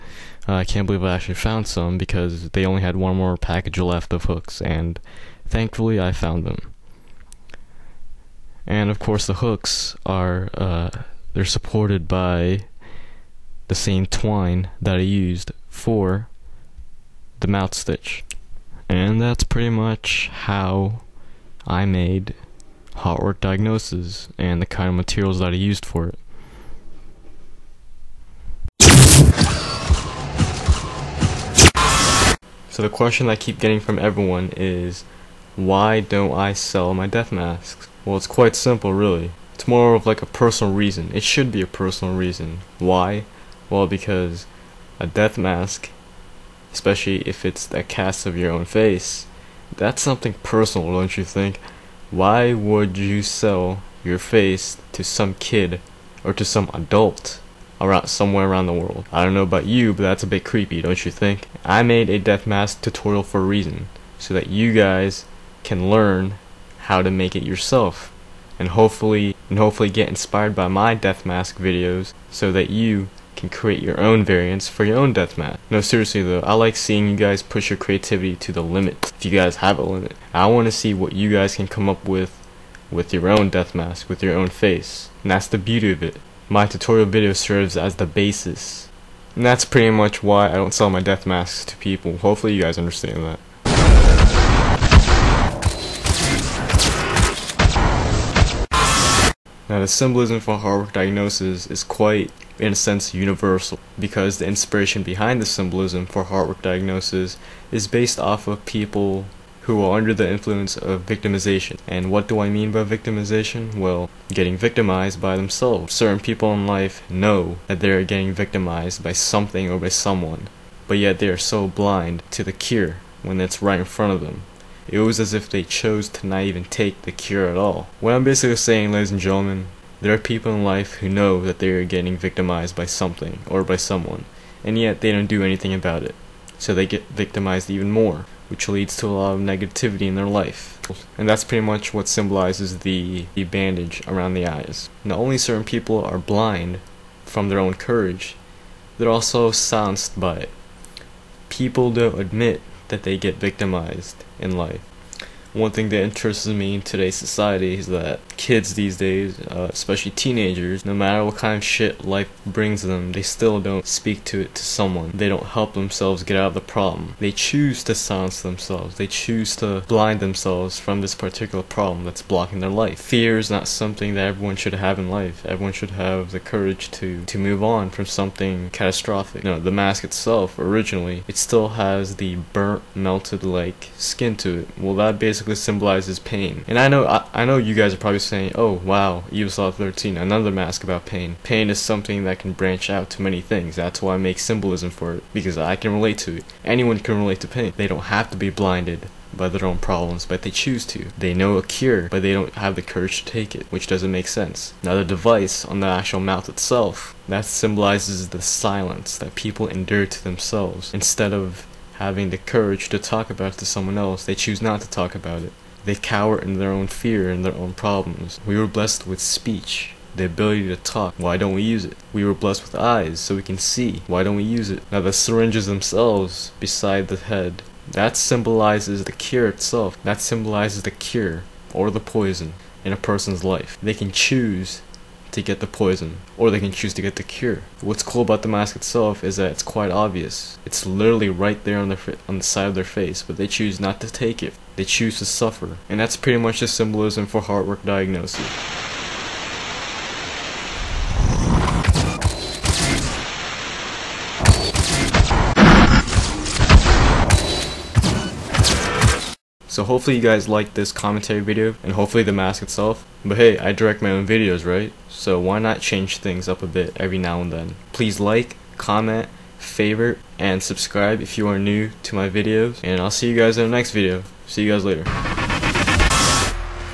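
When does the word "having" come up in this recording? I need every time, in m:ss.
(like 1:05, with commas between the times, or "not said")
3:32.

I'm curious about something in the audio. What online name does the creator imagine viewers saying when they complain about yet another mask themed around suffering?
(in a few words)
EvilSlaughter 13.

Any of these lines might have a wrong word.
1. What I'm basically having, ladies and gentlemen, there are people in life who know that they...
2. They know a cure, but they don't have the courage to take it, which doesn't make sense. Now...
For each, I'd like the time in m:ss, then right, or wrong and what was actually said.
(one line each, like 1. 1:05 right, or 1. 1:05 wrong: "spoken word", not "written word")
1. 2:08 wrong: "saying", not "having"
2. 3:21 right.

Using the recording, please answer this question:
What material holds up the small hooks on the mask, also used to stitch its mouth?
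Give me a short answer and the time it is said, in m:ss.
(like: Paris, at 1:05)
twine, at 0:14.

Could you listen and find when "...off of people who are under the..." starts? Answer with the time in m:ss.
1:48.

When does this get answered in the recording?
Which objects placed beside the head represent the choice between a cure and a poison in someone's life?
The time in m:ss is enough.
3:45.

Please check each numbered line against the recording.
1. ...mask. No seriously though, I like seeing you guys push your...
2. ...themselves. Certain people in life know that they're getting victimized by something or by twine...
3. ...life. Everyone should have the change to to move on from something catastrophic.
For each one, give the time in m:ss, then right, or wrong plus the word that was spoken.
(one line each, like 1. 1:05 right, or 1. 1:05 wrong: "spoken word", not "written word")
1. 1:15 right
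2. 1:55 wrong: "someone", not "twine"
3. 2:55 wrong: "courage", not "change".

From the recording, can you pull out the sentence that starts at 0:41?
It should be a personal reason.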